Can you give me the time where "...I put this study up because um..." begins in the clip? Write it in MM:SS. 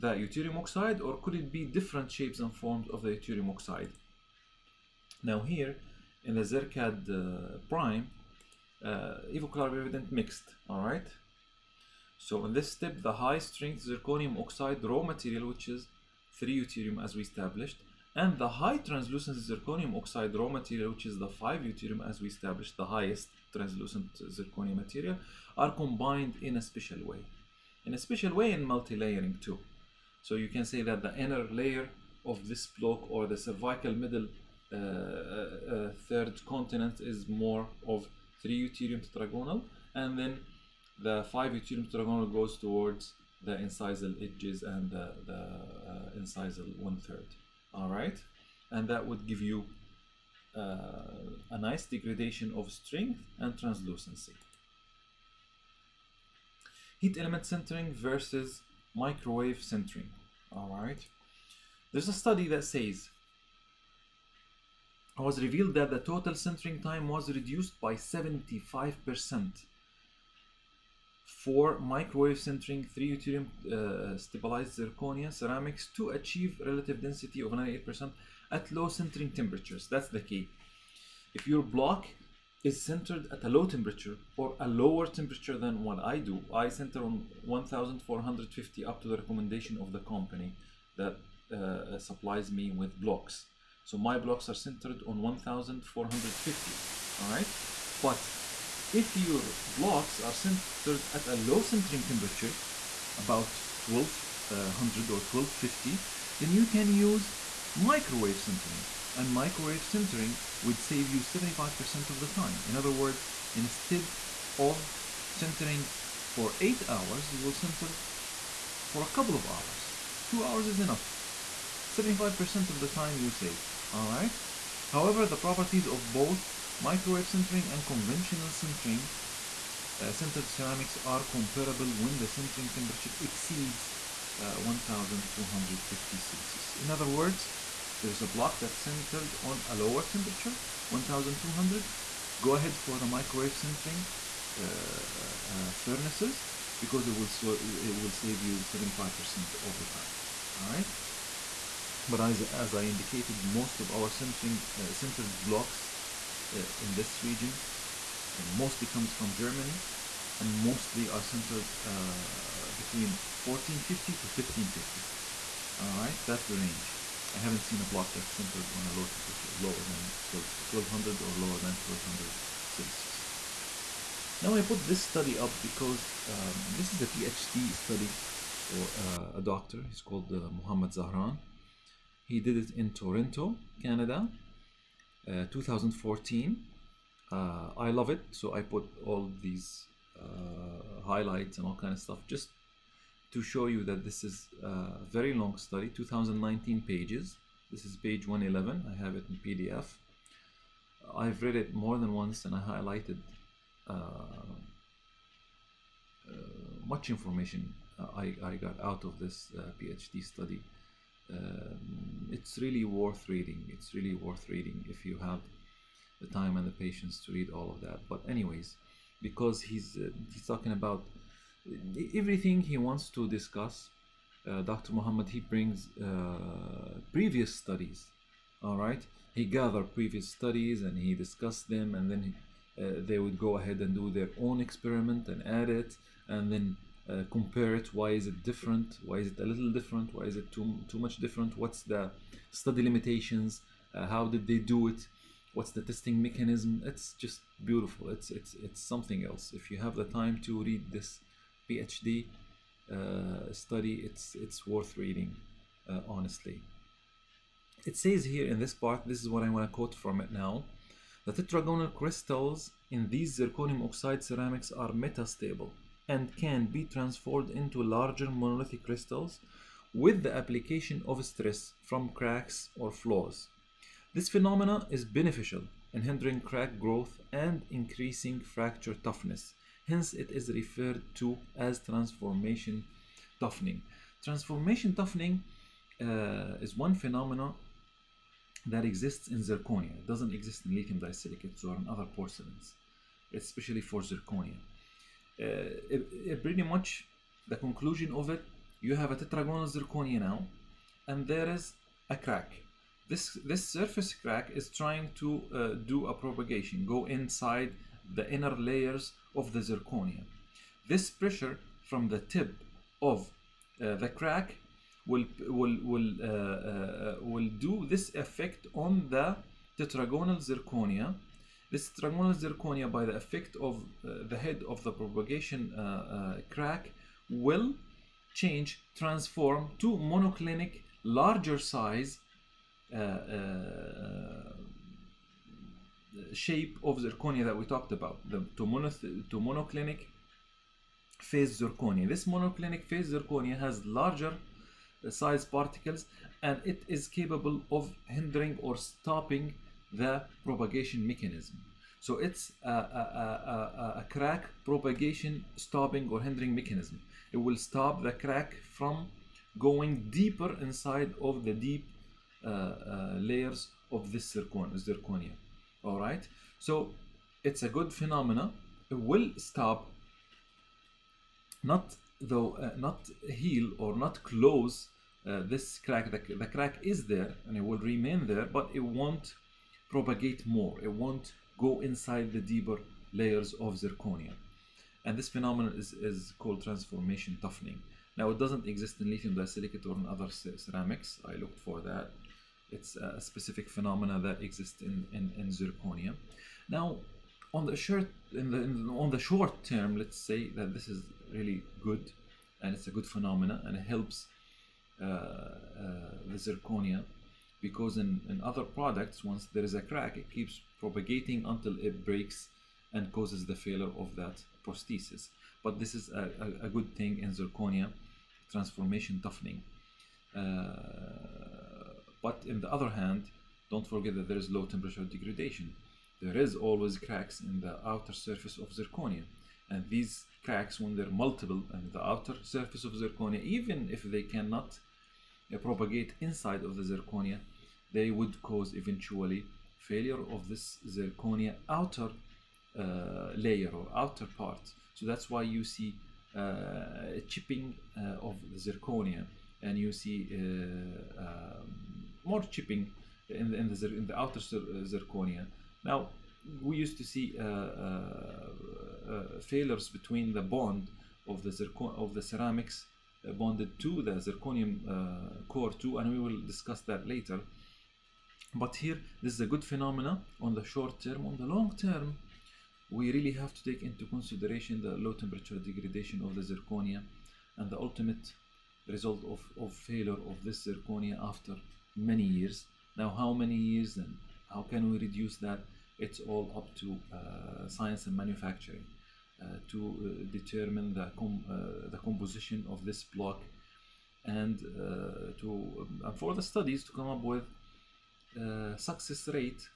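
02:54.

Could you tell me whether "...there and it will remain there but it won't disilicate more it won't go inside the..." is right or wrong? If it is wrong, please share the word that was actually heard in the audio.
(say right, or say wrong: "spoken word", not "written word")
wrong: "propagate", not "disilicate".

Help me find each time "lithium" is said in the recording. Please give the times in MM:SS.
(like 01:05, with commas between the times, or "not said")
04:50, 06:29.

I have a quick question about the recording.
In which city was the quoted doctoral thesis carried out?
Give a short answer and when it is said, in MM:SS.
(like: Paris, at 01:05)
Toronto, at 03:02.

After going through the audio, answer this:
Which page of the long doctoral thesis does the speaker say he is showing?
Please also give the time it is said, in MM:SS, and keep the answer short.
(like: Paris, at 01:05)
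111, at 03:17.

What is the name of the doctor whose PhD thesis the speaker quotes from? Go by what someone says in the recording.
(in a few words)
Muhammad Zahran.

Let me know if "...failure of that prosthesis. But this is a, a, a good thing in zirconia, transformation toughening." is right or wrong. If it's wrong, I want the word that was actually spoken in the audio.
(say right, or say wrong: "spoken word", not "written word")
right.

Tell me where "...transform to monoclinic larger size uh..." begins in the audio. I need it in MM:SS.
05:28.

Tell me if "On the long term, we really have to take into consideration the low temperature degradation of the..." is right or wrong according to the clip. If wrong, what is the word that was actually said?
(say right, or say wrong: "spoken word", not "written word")
right.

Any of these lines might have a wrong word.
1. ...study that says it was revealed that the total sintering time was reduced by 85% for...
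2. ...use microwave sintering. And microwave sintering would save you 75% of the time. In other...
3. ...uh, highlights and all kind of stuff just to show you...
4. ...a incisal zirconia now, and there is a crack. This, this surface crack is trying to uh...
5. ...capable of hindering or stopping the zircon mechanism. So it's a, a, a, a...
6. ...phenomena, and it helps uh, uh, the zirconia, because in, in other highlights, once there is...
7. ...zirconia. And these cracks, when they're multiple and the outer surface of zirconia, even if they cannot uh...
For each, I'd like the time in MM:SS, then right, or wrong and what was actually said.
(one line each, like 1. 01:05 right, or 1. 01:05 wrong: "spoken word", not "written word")
1. 01:02 wrong: "75", not "85"
2. 01:46 right
3. 03:10 right
4. 04:59 wrong: "tetragonal", not "incisal"
5. 05:47 wrong: "propagation", not "zircon"
6. 06:43 wrong: "products", not "highlights"
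7. 07:08 right.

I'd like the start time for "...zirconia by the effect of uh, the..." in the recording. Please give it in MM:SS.
05:22.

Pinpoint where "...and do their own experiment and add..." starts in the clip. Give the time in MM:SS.
03:53.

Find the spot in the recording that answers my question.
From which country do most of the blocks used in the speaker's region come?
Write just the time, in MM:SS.
02:39.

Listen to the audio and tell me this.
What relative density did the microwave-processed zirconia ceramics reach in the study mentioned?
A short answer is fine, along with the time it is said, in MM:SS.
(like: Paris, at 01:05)
98%, at 01:17.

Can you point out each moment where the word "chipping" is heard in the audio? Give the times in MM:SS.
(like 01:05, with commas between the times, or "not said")
07:27, 07:32.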